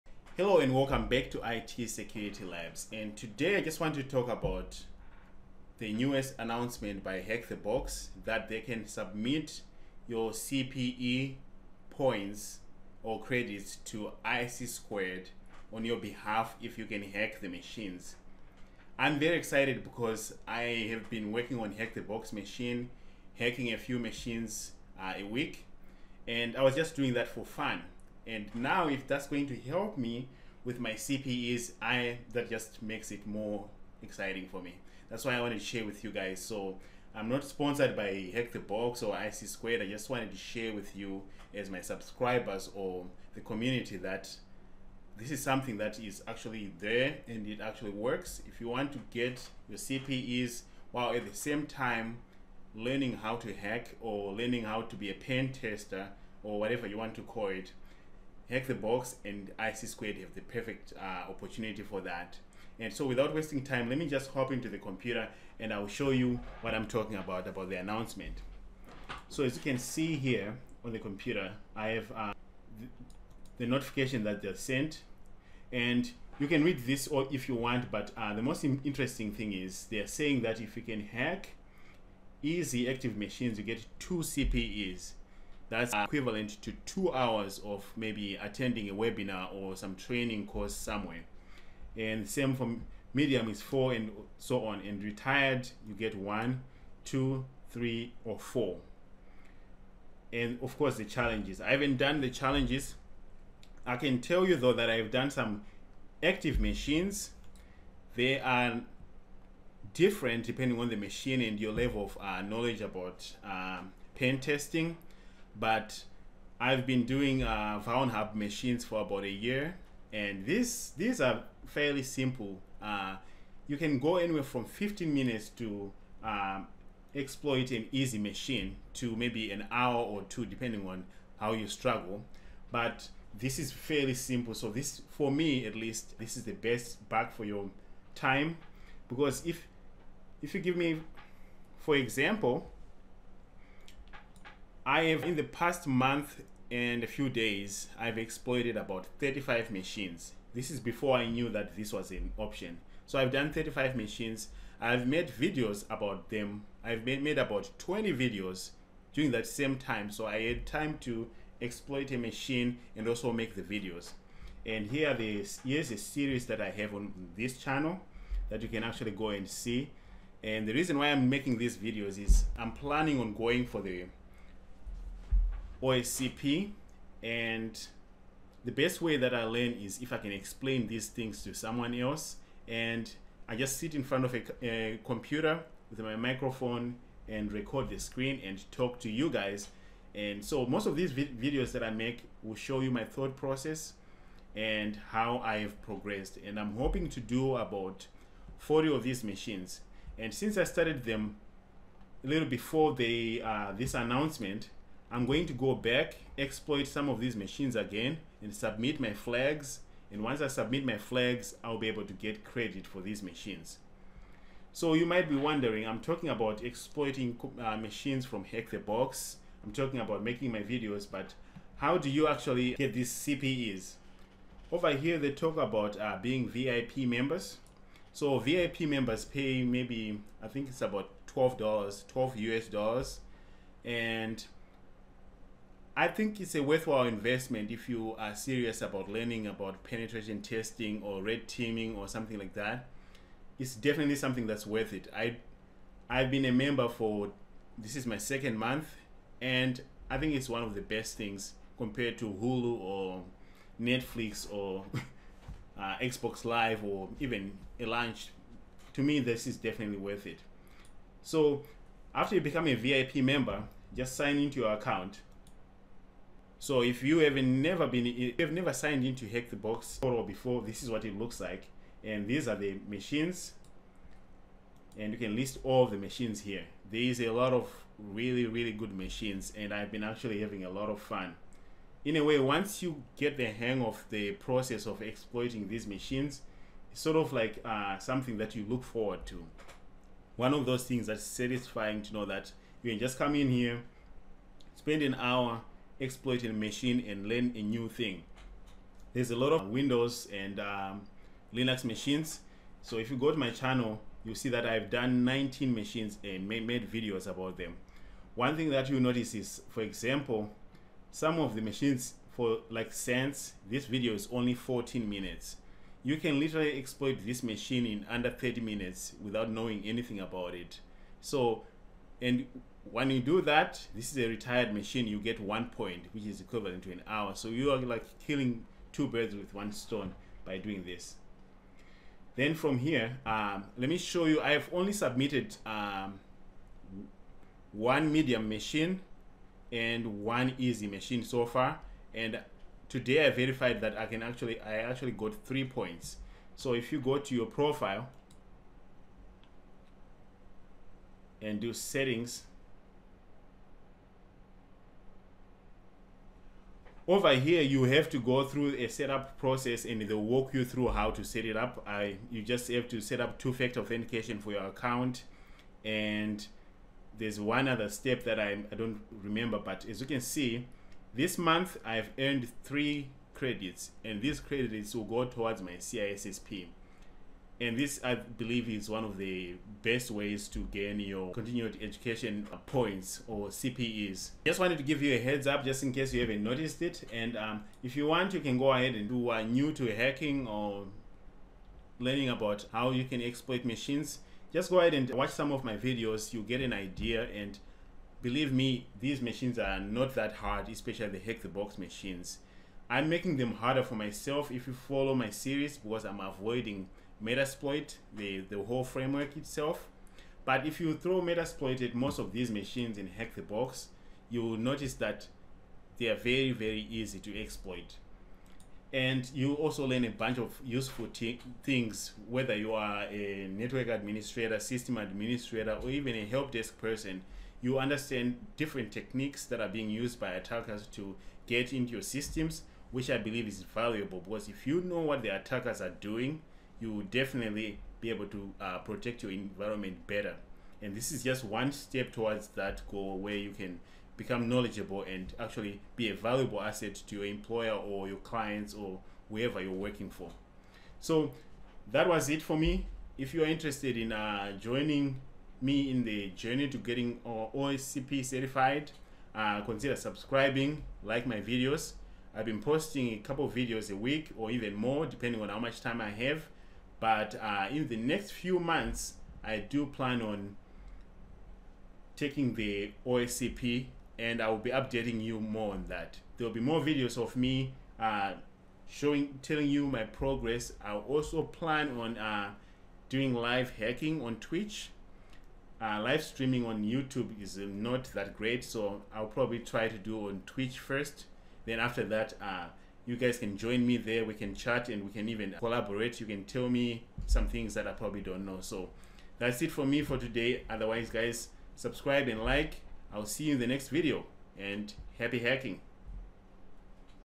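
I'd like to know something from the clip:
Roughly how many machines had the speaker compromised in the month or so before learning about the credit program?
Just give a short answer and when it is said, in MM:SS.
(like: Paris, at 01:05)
35, at 02:28.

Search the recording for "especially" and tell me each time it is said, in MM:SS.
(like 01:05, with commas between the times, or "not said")
06:40.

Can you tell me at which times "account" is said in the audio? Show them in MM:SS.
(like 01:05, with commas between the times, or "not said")
04:24, 06:04.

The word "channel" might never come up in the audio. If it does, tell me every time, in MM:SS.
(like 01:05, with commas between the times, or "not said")
02:47, 05:03.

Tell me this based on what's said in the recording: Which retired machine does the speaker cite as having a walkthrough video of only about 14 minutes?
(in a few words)
Sense.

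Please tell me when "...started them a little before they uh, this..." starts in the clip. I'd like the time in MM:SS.
03:20.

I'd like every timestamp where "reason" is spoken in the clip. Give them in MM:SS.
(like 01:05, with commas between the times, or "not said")
02:50.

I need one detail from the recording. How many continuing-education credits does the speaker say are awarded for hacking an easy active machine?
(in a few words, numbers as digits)
2.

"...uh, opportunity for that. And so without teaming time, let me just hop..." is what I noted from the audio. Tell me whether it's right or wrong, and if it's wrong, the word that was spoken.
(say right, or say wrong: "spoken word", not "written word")
wrong: "wasting", not "teaming".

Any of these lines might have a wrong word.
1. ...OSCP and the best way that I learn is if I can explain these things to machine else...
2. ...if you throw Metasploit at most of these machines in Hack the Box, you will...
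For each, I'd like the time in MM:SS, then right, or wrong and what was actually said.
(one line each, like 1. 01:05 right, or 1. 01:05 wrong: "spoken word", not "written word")
1. 02:55 wrong: "someone", not "machine"
2. 06:50 right.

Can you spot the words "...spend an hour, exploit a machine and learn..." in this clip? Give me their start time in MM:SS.
04:54.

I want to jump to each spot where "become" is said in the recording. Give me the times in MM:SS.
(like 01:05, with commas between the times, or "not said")
04:22, 07:24.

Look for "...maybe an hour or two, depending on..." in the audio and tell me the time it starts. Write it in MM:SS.
02:09.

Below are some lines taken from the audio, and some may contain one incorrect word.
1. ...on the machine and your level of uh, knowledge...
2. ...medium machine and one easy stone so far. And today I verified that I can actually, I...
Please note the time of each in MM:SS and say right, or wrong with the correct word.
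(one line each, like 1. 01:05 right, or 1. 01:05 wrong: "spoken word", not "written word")
1. 01:50 right
2. 05:38 wrong: "machine", not "stone".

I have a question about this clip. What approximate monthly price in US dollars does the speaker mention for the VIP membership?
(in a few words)
$12.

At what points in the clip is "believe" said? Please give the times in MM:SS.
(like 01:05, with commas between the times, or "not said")
06:18, 06:38, 07:13.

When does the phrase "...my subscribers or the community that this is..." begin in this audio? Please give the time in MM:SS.
00:41.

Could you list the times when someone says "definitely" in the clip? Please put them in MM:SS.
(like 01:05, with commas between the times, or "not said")
04:03, 04:19, 07:17.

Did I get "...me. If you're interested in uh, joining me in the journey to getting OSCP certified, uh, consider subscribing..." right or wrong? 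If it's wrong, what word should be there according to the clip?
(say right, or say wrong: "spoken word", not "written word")
right.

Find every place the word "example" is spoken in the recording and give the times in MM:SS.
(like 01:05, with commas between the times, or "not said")
02:21, 05:09.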